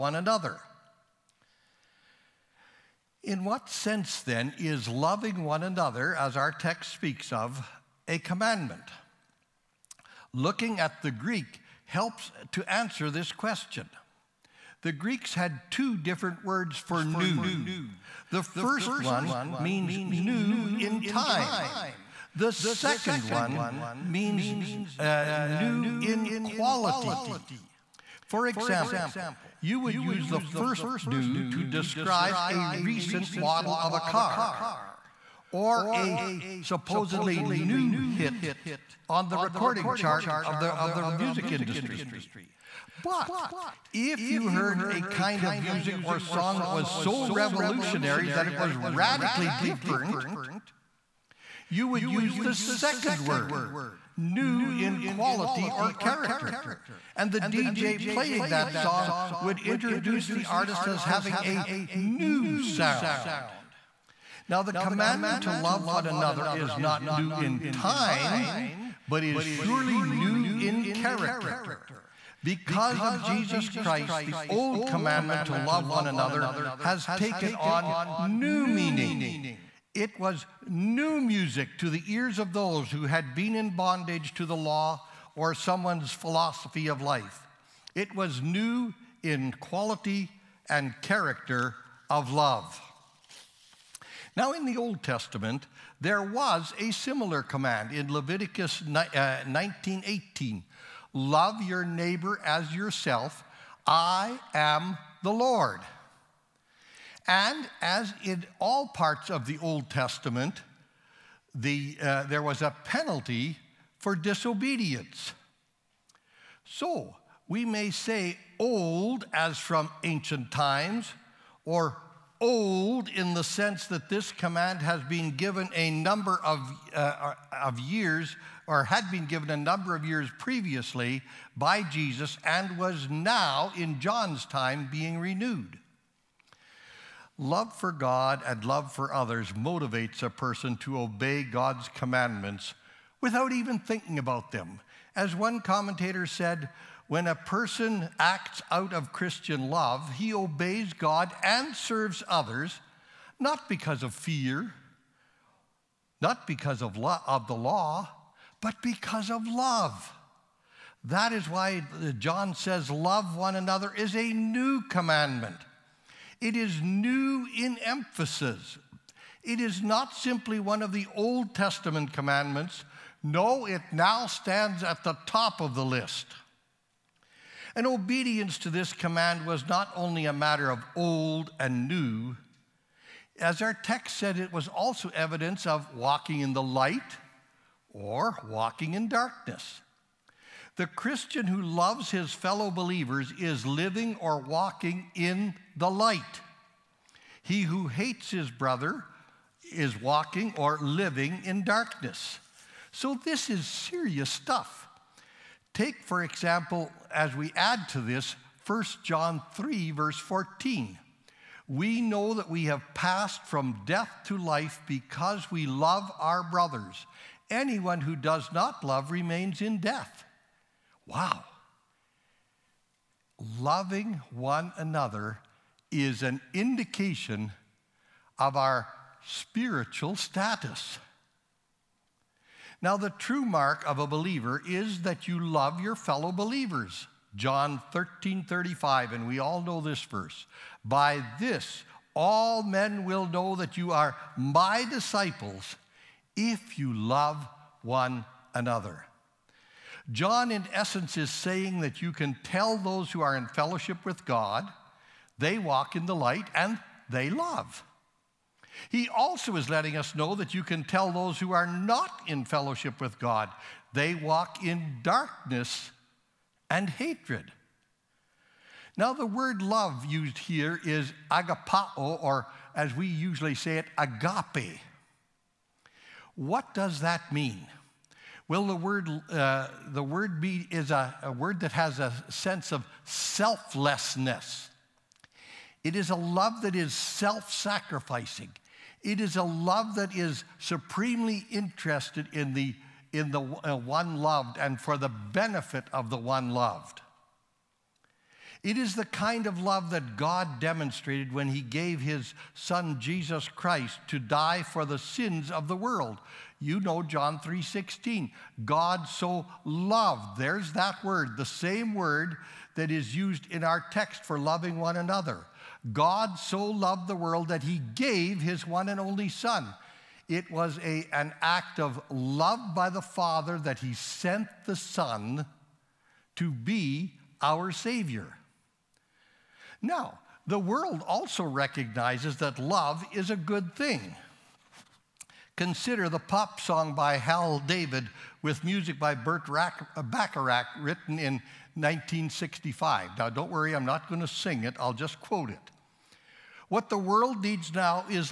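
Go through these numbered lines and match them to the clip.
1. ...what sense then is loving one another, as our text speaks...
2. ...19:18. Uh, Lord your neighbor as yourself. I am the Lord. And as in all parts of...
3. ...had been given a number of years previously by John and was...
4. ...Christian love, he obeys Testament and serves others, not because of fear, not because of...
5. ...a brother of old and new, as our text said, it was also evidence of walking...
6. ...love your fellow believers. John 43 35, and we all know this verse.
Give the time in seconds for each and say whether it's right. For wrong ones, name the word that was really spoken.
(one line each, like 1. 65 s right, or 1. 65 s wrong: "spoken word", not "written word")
1. 3 s right
2. 98 s wrong: "Love", not "Lord"
3. 128 s wrong: "Jesus", not "John"
4. 149 s wrong: "God", not "Testament"
5. 180 s wrong: "matter", not "brother"
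6. 235 s wrong: "13", not "43".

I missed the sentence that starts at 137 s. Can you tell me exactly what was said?
Love for God and love for others motivates a person to obey God's commandments without even thinking about them.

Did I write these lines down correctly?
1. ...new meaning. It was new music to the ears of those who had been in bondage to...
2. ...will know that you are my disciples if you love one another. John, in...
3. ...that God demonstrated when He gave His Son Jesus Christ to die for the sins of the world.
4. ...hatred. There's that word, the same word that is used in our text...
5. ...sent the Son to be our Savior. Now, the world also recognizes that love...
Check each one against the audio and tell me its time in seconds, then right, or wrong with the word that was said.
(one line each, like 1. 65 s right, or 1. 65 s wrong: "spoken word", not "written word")
1. 78 s right
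2. 243 s right
3. 299 s right
4. 309 s wrong: "loved", not "hatred"
5. 323 s right.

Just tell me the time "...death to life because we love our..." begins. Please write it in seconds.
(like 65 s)
213 s.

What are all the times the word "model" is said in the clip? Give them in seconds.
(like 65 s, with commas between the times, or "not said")
33 s.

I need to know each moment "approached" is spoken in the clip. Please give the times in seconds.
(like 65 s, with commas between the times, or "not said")
not said.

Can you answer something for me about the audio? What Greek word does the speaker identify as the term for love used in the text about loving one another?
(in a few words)
agapao.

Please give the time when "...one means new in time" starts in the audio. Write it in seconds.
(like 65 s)
18 s.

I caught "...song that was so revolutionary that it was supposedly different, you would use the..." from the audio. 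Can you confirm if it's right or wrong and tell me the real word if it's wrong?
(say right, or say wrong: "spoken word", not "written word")
wrong: "radically", not "supposedly".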